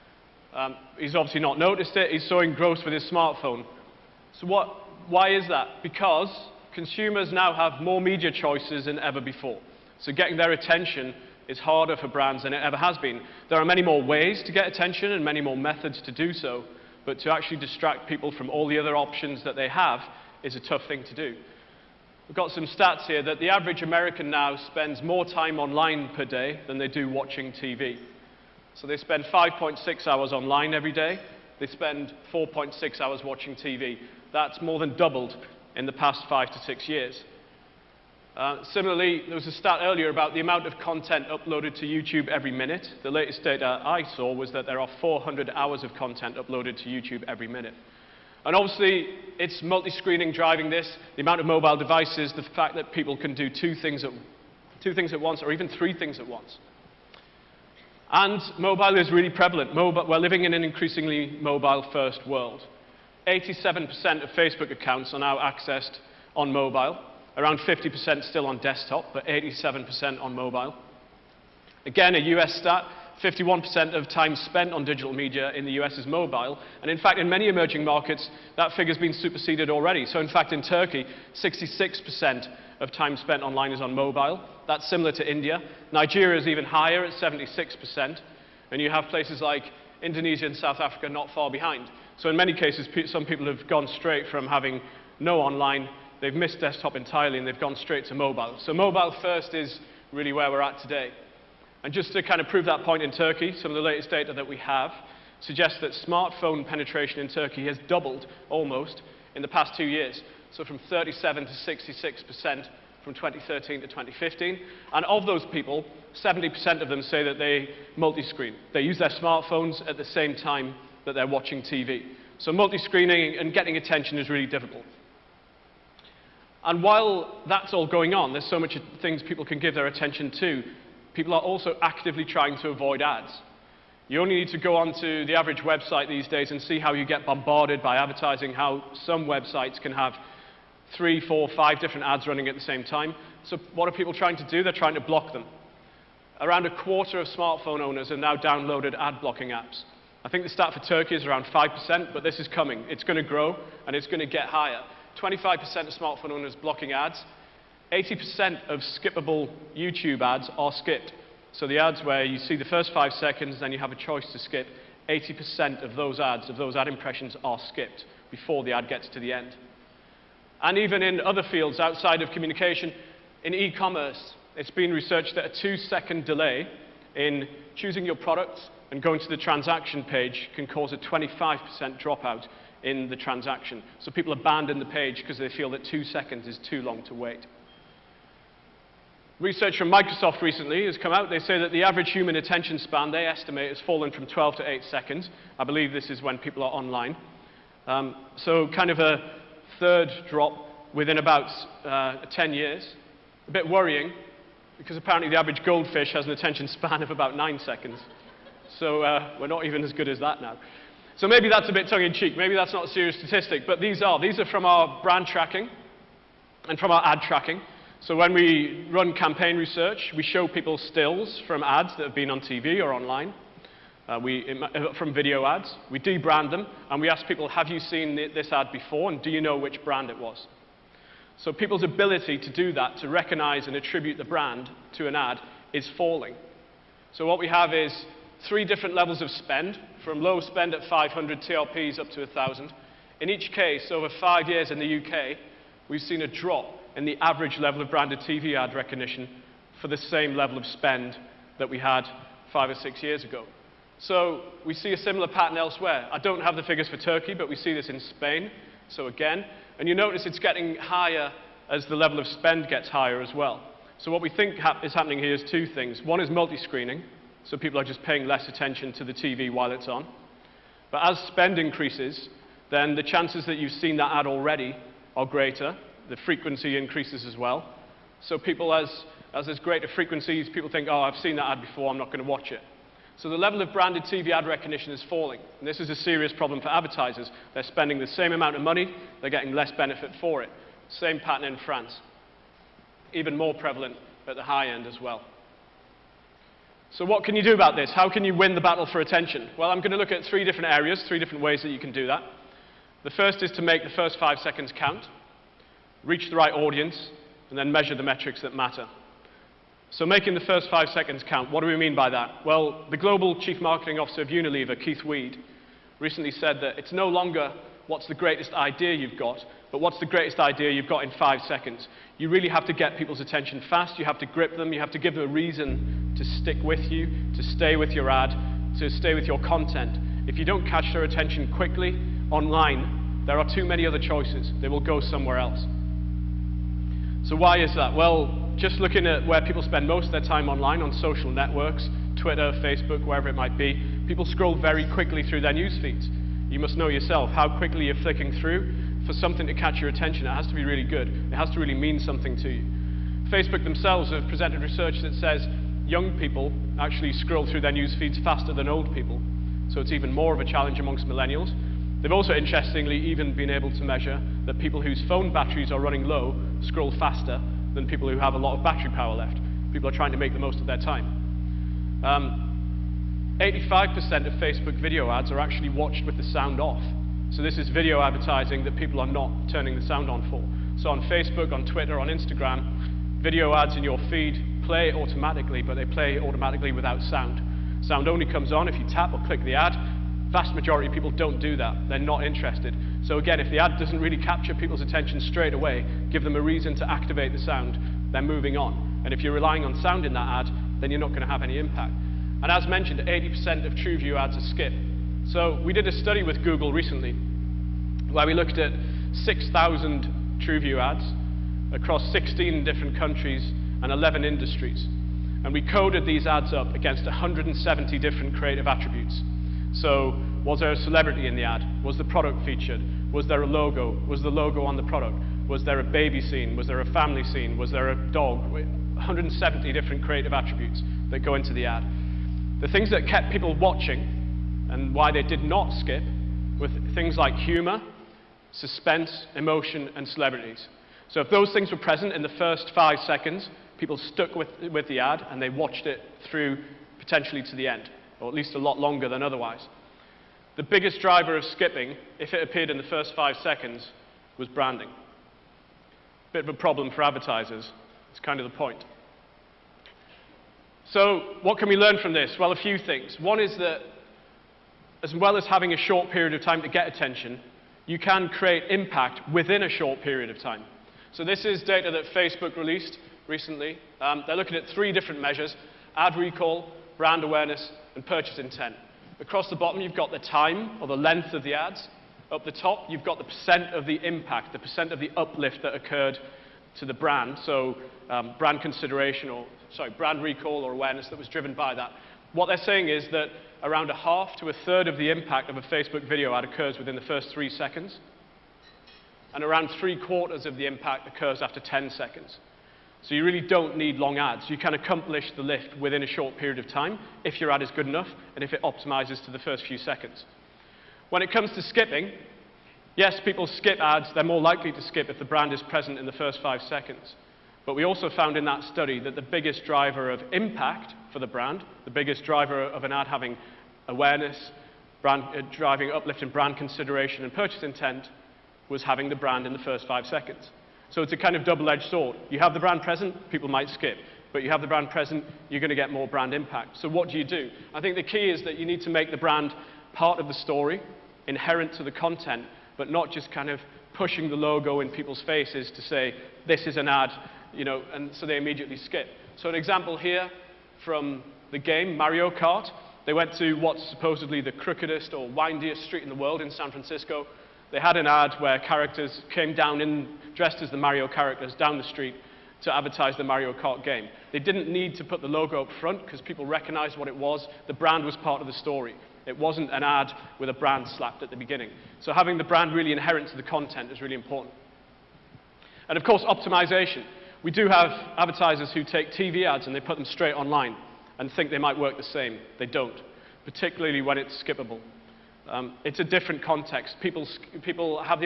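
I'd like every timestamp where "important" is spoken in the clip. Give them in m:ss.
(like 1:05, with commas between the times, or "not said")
9:34.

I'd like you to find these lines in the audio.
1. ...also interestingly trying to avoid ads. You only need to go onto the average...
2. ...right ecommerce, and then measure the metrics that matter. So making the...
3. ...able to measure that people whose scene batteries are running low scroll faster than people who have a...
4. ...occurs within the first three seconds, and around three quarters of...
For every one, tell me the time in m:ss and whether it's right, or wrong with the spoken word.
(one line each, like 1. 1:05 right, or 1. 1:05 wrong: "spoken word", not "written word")
1. 2:11 wrong: "actively", not "interestingly"
2. 5:06 wrong: "audience", not "ecommerce"
3. 6:03 wrong: "phone", not "scene"
4. 8:16 right.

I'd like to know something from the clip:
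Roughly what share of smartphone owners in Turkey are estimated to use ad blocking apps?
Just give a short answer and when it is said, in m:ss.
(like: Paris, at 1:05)
5%, at 2:31.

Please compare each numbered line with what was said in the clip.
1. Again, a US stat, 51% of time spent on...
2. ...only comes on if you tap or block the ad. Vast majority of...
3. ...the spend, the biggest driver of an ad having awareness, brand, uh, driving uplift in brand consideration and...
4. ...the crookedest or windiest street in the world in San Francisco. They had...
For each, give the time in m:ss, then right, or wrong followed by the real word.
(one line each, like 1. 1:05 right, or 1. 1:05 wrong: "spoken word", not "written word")
1. 1:11 right
2. 6:28 wrong: "click", not "block"
3. 8:41 wrong: "brand", not "spend"
4. 9:14 right.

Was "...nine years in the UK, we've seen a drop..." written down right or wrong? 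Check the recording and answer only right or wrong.
wrong.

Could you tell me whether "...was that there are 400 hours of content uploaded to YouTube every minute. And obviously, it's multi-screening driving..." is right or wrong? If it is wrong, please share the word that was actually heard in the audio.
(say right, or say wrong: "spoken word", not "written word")
right.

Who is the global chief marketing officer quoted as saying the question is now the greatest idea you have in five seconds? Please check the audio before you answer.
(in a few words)
Keith Weed.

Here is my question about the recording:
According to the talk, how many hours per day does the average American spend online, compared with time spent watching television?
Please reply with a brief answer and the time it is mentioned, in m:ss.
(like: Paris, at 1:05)
5.6 hours, at 0:29.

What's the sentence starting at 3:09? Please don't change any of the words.
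Research from Microsoft recently has come out.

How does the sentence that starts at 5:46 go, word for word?
You must know yourself how quickly you're flicking through.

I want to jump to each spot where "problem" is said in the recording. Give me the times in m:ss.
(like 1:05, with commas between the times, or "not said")
4:46, 7:36.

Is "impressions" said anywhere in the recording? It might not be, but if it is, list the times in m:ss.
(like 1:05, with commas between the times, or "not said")
2:46.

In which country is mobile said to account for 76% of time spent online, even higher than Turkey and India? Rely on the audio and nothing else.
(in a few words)
Nigeria.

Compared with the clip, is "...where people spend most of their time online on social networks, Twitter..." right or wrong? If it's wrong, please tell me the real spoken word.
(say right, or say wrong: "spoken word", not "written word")
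right.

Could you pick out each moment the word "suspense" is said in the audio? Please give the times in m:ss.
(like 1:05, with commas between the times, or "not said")
7:18.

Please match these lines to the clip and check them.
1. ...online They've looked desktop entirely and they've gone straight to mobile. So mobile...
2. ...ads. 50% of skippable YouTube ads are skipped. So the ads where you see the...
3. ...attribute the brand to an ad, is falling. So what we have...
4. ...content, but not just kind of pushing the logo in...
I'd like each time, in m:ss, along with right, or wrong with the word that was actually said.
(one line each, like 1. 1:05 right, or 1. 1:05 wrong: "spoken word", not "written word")
1. 1:35 wrong: "missed", not "looked"
2. 2:36 wrong: "80", not "50"
3. 3:53 right
4. 9:01 right.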